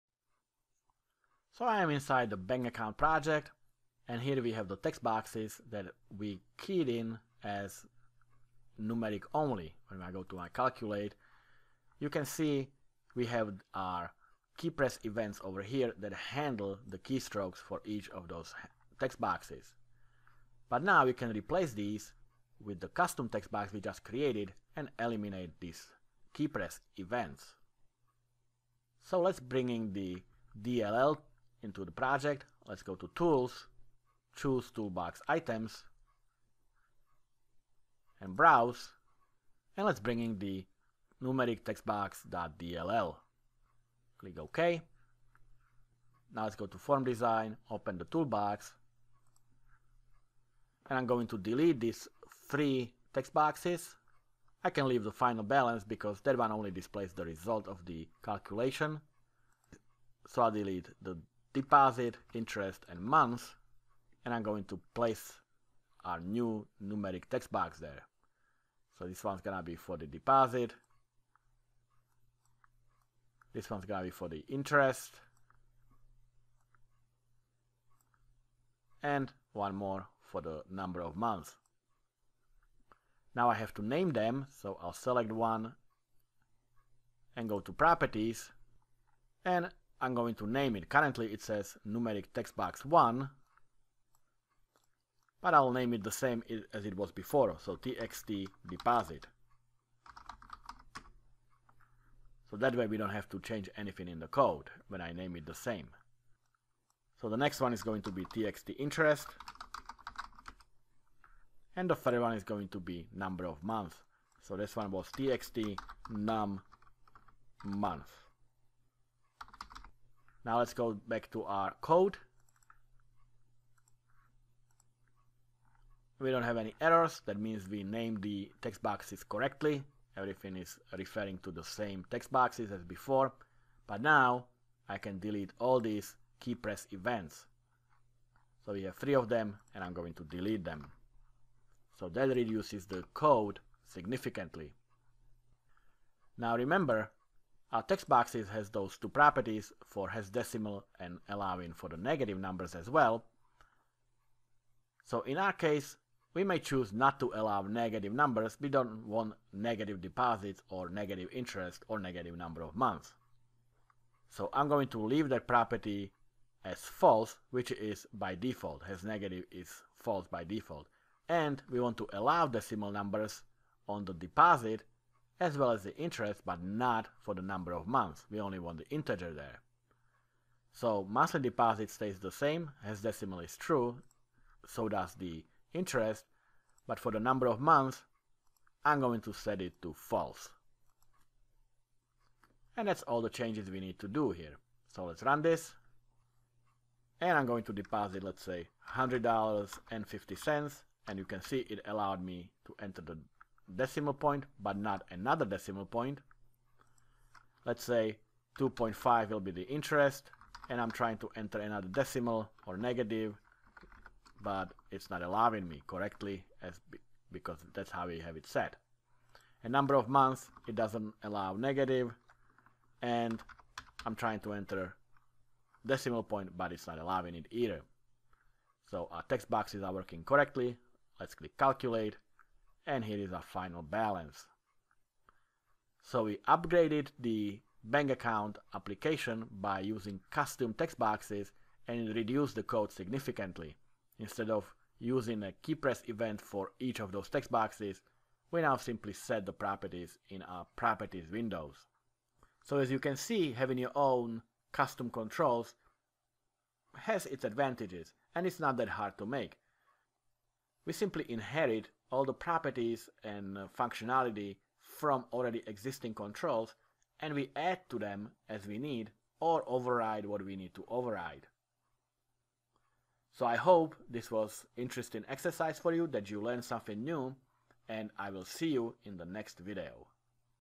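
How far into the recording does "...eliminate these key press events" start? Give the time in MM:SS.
00:24.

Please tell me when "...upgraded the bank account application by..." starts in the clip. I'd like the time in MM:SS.
03:56.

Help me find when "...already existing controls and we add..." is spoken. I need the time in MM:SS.
04:25.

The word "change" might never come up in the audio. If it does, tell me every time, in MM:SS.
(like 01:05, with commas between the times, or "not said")
01:43, 03:13.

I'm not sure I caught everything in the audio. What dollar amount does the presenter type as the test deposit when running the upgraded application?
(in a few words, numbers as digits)
$100.50.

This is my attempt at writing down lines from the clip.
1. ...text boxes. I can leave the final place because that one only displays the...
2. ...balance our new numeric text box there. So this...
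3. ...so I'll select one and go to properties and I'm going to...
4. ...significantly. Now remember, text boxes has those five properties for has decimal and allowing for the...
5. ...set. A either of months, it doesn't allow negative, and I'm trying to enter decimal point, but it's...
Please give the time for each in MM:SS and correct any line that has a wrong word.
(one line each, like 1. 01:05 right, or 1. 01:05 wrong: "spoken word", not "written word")
1. 00:53 wrong: "balance", not "place"
2. 01:04 wrong: "place", not "balance"
3. 01:24 right
4. 02:23 wrong: "two", not "five"
5. 03:38 wrong: "number", not "either".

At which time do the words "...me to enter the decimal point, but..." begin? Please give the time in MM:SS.
03:22.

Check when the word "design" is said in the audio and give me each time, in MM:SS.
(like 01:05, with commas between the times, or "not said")
00:47.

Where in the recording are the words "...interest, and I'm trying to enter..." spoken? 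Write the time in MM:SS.
03:29.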